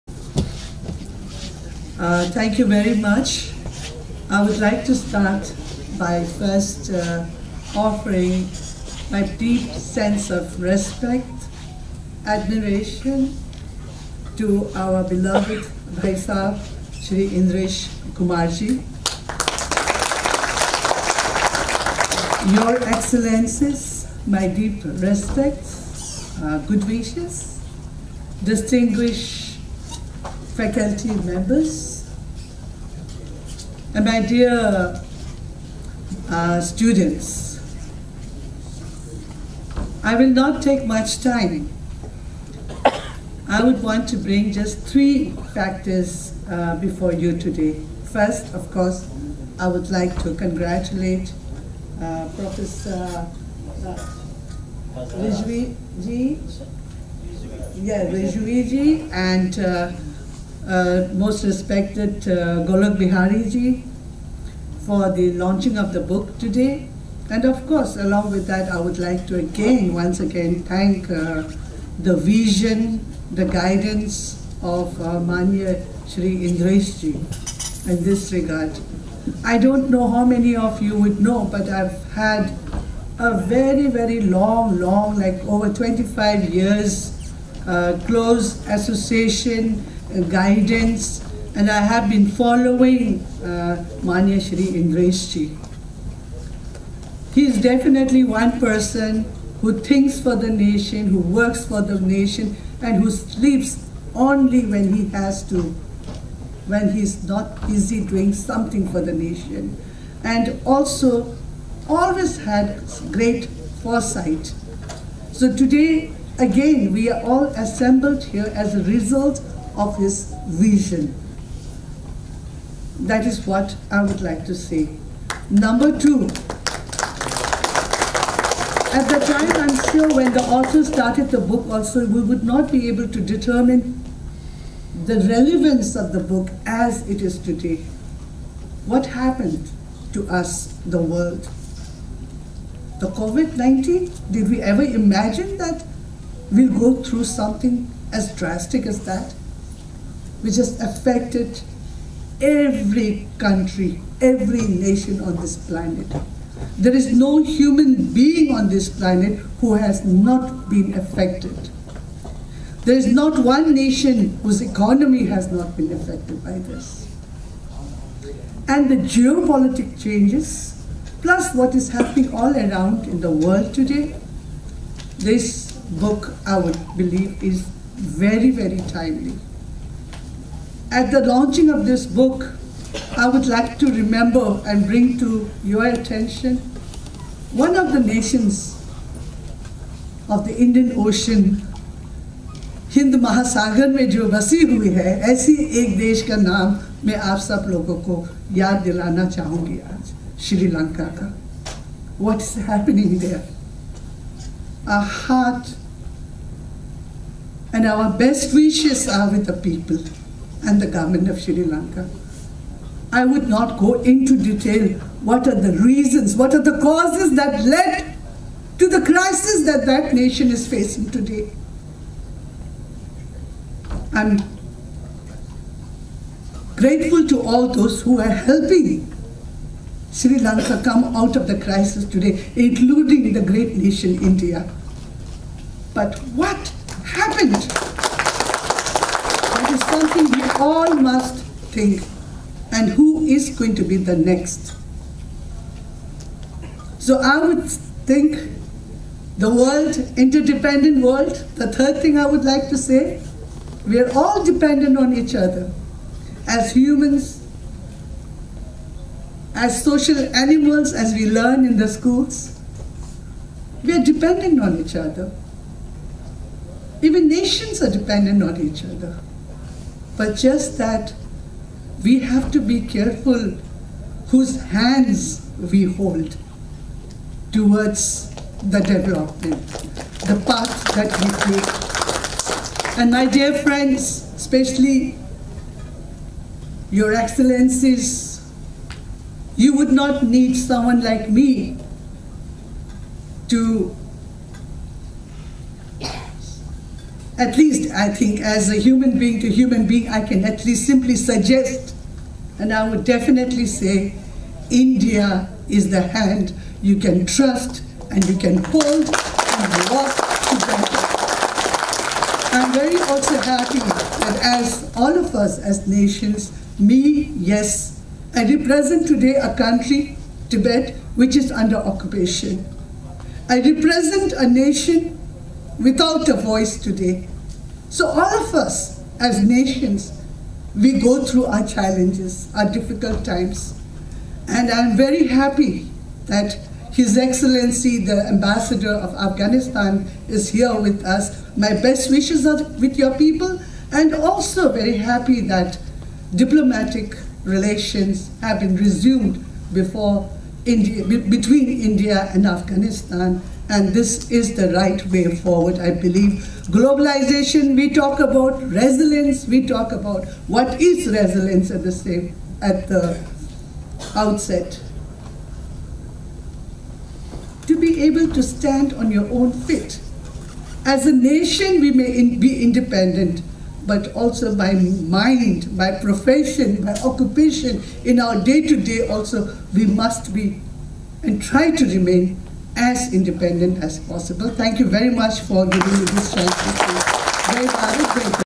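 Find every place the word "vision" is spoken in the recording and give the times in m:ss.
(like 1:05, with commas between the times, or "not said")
1:12, 2:00.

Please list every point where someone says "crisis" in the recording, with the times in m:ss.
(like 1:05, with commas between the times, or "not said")
3:39, 3:51.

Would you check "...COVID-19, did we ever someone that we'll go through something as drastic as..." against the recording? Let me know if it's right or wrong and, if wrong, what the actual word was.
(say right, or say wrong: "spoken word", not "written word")
wrong: "imagine", not "someone".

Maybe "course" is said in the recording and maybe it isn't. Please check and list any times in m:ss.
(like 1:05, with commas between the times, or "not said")
0:48, 1:07.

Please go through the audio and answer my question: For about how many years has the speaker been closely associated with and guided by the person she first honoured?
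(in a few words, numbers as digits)
Over 25 years.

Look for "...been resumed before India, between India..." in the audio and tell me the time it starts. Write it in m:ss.
5:48.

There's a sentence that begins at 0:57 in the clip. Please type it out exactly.
Yeah, Rijvi Ji and uh, uh, most respected uh, Golok Bihariji for the launching of the book today.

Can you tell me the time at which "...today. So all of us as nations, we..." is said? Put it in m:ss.
5:26.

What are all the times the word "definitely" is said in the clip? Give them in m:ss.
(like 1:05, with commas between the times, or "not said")
1:37, 5:03.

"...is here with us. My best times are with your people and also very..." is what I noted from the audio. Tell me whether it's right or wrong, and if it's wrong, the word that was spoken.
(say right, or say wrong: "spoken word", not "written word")
wrong: "wishes", not "times".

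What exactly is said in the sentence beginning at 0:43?
I would want to bring just three factors uh, before you today.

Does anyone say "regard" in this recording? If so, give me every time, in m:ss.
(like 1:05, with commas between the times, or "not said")
1:18.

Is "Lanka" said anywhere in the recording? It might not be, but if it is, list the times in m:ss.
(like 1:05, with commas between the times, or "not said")
3:20, 3:31, 3:50.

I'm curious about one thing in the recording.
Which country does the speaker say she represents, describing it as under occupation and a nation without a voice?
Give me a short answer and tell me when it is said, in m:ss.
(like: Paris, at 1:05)
Tibet, at 5:20.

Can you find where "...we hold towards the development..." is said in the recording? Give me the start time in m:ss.
4:35.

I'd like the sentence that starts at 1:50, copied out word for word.
And also always had great foresight.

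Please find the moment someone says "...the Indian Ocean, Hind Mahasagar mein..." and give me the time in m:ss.
3:10.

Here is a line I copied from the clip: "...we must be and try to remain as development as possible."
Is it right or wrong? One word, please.
wrong.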